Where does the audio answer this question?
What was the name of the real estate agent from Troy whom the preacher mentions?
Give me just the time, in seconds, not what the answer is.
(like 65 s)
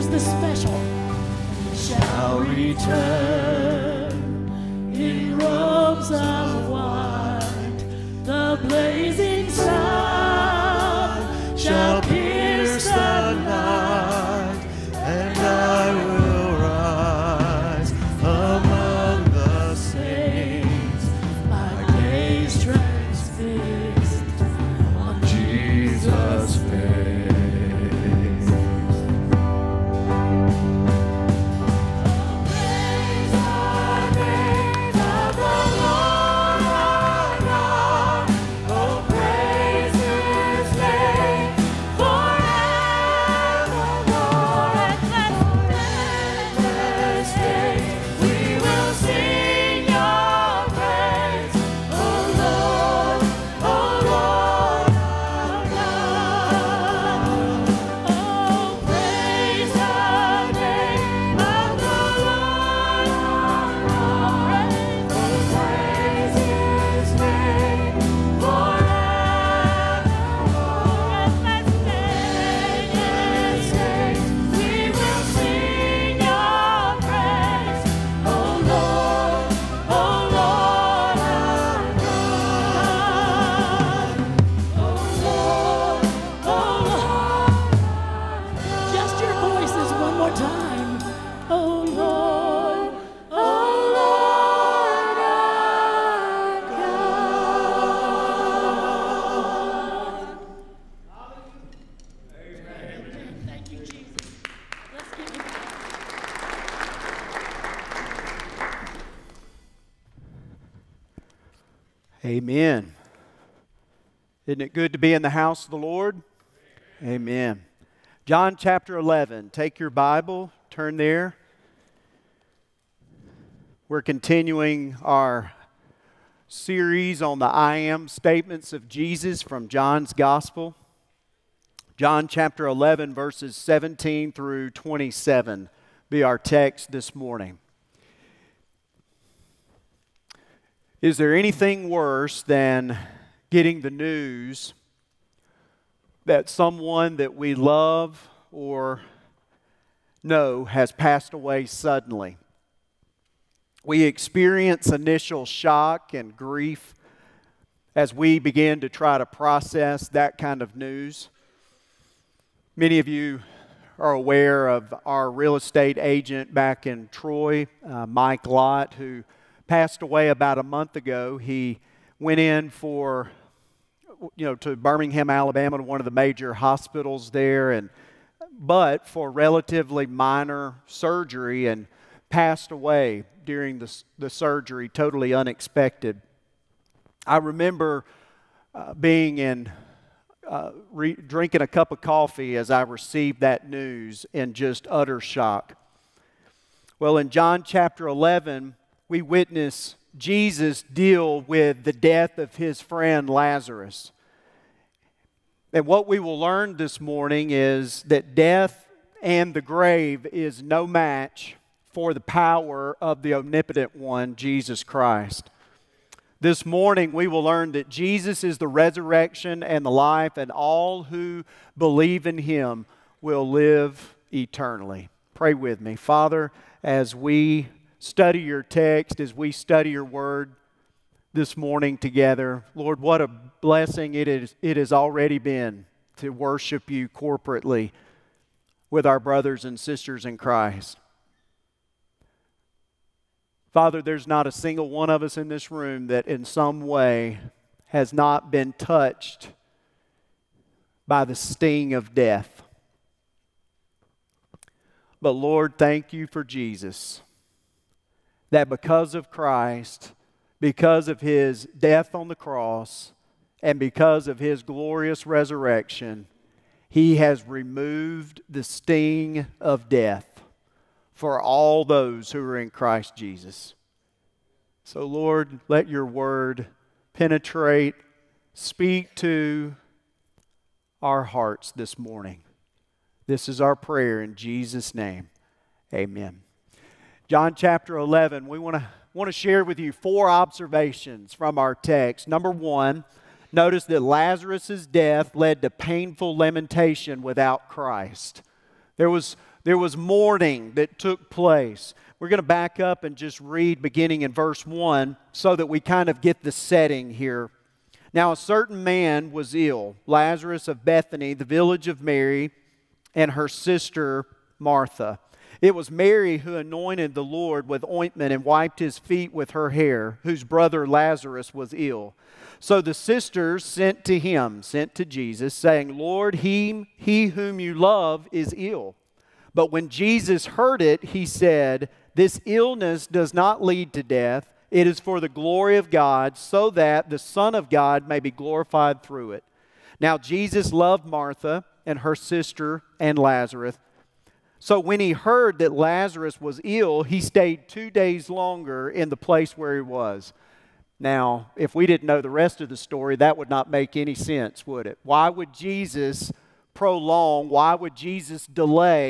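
168 s.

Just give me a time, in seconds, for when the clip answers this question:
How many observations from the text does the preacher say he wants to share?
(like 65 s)
289 s.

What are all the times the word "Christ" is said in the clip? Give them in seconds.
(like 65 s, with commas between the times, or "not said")
214 s, 240 s, 259 s, 272 s, 297 s.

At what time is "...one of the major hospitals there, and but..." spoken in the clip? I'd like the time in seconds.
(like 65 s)
175 s.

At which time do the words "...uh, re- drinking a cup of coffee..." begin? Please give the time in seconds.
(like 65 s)
190 s.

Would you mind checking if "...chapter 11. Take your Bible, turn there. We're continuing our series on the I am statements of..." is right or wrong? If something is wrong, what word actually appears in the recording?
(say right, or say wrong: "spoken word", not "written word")
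right.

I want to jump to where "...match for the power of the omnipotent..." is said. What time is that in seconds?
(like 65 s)
210 s.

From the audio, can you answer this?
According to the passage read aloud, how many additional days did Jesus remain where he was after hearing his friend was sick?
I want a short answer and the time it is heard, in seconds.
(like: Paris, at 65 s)
2, at 347 s.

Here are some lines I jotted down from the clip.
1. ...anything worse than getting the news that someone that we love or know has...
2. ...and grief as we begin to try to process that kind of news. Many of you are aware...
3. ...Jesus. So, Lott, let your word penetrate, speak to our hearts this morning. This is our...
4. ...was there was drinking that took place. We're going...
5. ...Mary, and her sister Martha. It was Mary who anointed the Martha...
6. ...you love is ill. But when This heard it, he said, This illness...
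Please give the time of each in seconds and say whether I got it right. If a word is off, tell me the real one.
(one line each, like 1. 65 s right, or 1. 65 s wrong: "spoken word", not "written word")
1. 141 s right
2. 156 s right
3. 273 s wrong: "Lord", not "Lott"
4. 299 s wrong: "mourning", not "drinking"
5. 312 s wrong: "Lord", not "Martha"
6. 327 s wrong: "Jesus", not "This".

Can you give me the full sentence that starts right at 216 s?
This morning, we will learn that Jesus is the resurrection and the life, and all who believe in him will live eternally.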